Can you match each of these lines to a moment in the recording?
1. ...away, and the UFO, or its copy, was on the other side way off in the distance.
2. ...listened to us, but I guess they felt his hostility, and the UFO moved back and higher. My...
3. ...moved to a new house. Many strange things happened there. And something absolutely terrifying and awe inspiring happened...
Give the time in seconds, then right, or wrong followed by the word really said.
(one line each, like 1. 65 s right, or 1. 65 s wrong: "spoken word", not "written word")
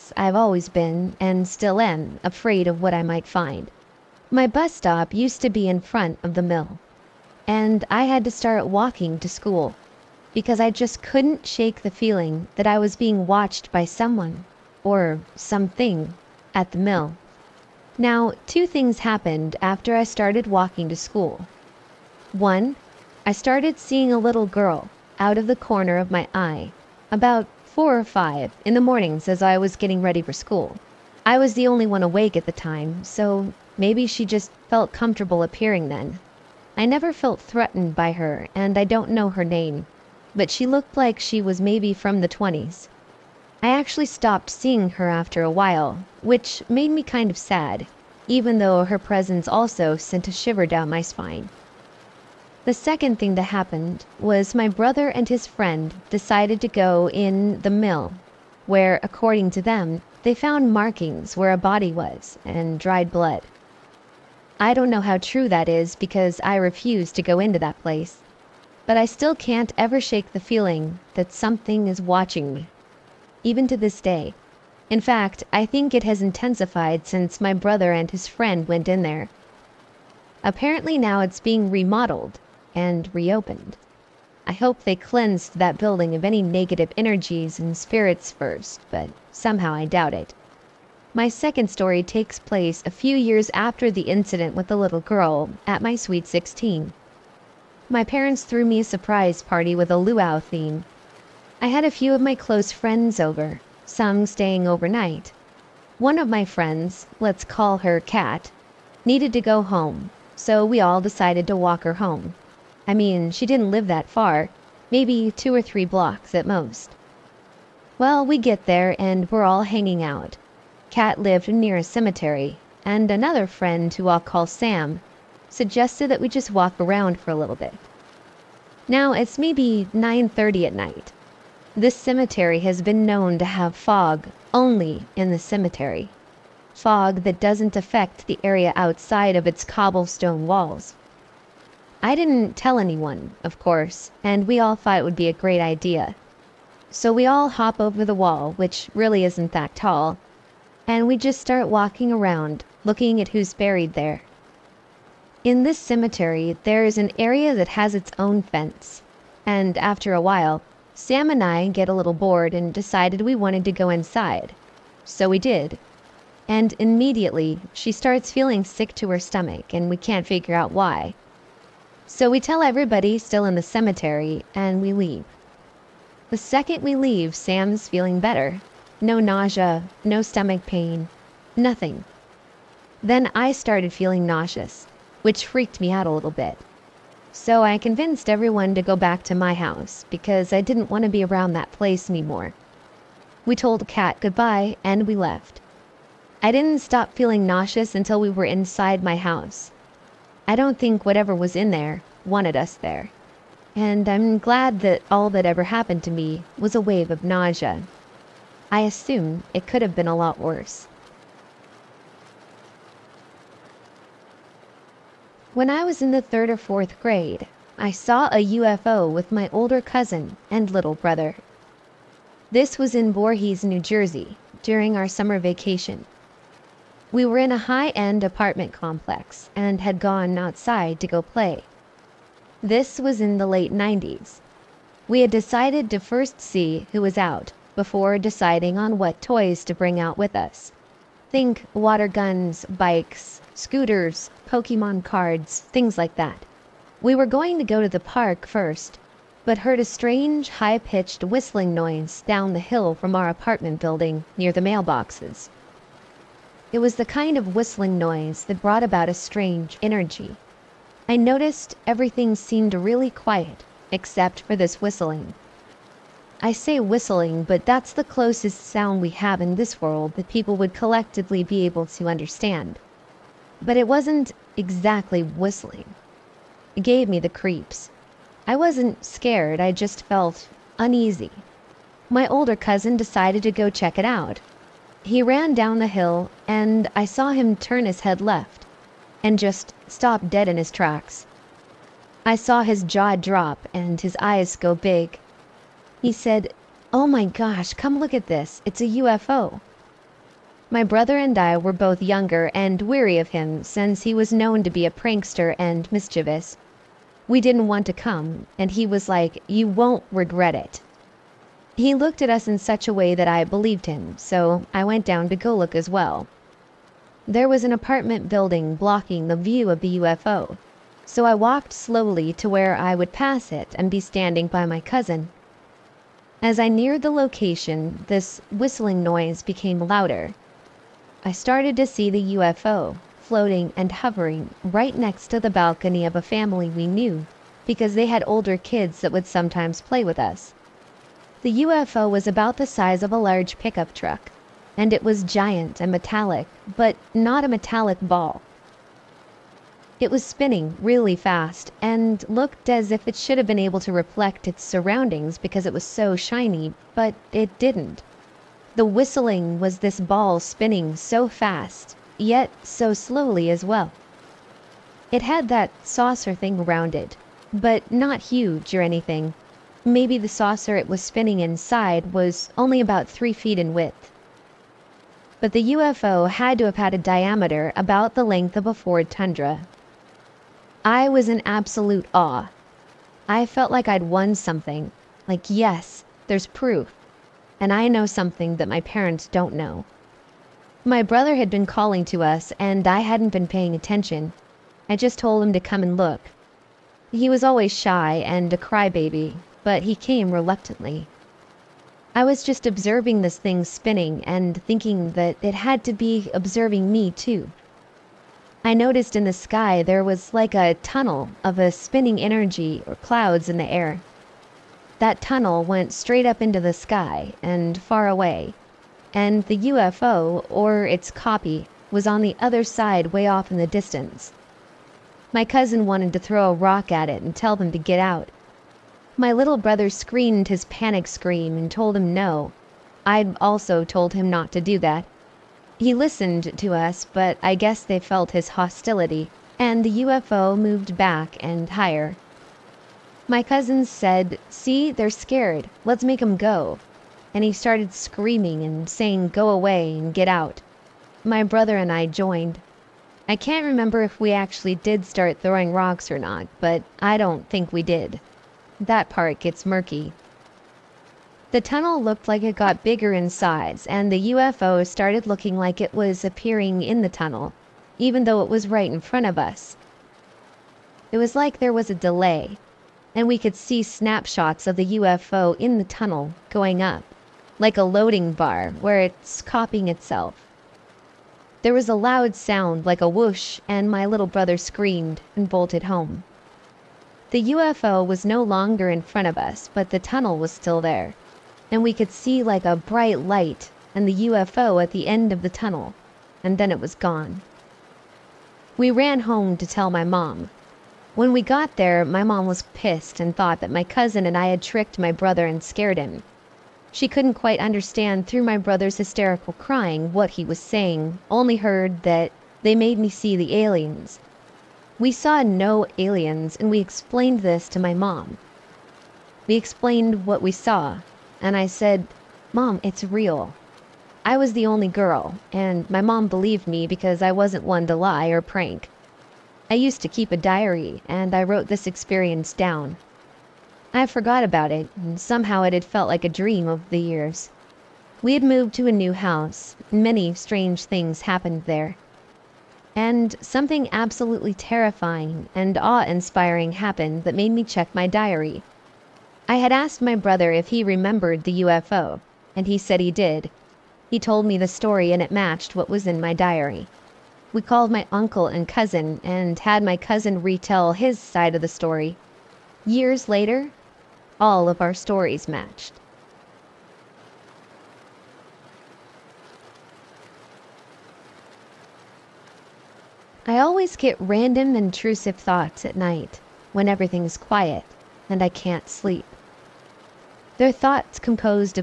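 1. 418 s right
2. 435 s right
3. 538 s right.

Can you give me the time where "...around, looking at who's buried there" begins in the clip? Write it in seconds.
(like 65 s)
152 s.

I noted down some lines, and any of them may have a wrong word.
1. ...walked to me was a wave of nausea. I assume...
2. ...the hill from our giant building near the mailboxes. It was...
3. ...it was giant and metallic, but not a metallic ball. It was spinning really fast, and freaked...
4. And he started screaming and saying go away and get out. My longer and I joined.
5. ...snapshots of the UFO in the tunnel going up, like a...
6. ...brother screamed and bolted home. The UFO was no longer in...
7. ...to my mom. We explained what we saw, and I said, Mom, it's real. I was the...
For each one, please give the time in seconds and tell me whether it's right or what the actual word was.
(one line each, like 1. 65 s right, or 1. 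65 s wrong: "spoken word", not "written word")
1. 205 s wrong: "happened", not "walked"
2. 252 s wrong: "apartment", not "giant"
3. 344 s wrong: "looked", not "freaked"
4. 447 s wrong: "brother", not "longer"
5. 473 s right
6. 484 s right
7. 517 s right.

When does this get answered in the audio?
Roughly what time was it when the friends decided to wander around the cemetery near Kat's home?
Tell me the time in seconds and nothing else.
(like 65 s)
129 s.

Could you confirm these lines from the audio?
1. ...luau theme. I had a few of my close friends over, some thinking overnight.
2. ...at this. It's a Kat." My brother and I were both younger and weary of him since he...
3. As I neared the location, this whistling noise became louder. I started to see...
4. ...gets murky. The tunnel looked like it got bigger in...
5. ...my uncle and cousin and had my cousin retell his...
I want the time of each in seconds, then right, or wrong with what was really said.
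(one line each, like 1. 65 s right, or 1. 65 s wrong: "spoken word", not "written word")
1. 99 s wrong: "staying", not "thinking"
2. 298 s wrong: "UFO", not "Kat"
3. 326 s right
4. 459 s right
5. 557 s right.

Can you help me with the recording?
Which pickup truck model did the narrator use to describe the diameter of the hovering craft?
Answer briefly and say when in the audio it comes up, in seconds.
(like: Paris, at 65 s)
Ford Tundra, at 378 s.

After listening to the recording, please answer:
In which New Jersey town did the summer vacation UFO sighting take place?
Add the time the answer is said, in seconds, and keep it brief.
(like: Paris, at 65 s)
Voorhees, at 223 s.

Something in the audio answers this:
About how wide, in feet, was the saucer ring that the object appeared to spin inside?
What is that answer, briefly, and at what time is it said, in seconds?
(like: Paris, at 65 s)
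3 feet, at 373 s.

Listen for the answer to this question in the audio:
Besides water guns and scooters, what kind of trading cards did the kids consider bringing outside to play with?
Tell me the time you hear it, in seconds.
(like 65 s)
244 s.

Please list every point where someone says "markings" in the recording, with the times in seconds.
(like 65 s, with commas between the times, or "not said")
60 s.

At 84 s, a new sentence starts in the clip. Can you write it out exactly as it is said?
I hope they cleansed that building of any negative energies and spirits first, but somehow I doubt it.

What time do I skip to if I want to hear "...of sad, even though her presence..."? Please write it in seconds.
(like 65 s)
47 s.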